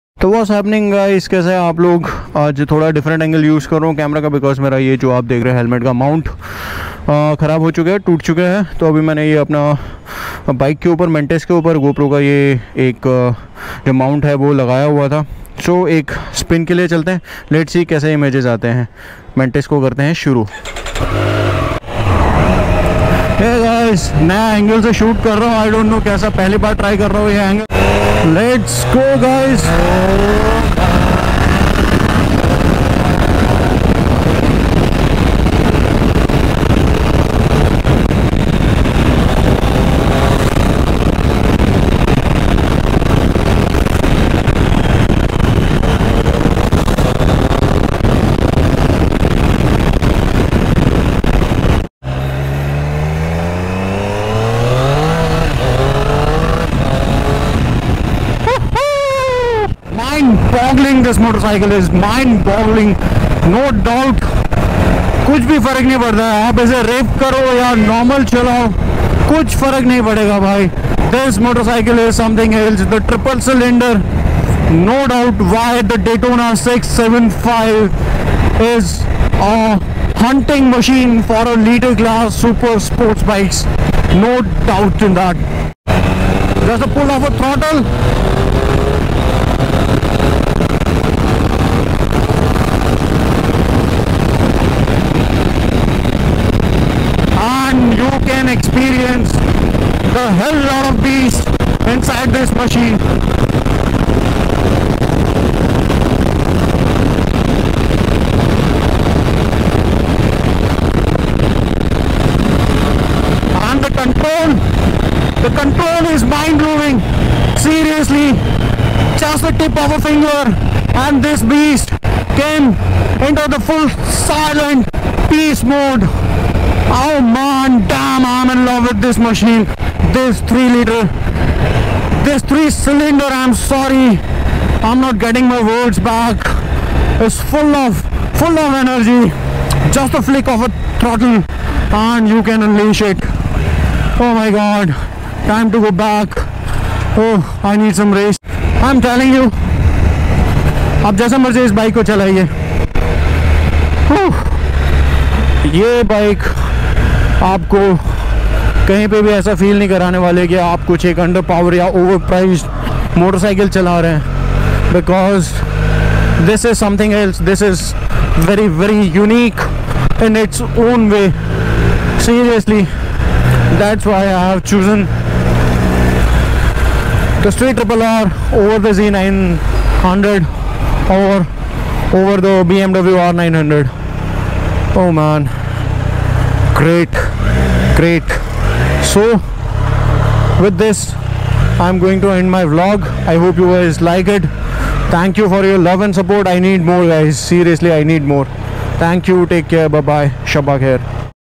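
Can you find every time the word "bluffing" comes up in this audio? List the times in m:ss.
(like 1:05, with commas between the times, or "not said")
not said.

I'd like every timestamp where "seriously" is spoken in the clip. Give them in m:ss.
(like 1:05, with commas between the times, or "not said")
1:57, 3:17.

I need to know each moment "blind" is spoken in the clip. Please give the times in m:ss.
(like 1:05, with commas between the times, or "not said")
not said.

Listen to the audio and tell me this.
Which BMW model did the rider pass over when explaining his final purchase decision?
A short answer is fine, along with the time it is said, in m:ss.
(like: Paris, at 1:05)
BMW R 900, at 3:02.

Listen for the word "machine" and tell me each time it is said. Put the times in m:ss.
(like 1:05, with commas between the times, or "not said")
1:20, 1:42, 2:09.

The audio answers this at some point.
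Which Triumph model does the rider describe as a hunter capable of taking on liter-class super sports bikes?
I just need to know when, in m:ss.
1:16.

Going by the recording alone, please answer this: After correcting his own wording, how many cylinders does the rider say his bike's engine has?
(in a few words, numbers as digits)
3.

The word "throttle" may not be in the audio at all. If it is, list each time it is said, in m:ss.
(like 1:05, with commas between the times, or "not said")
1:27, 2:20.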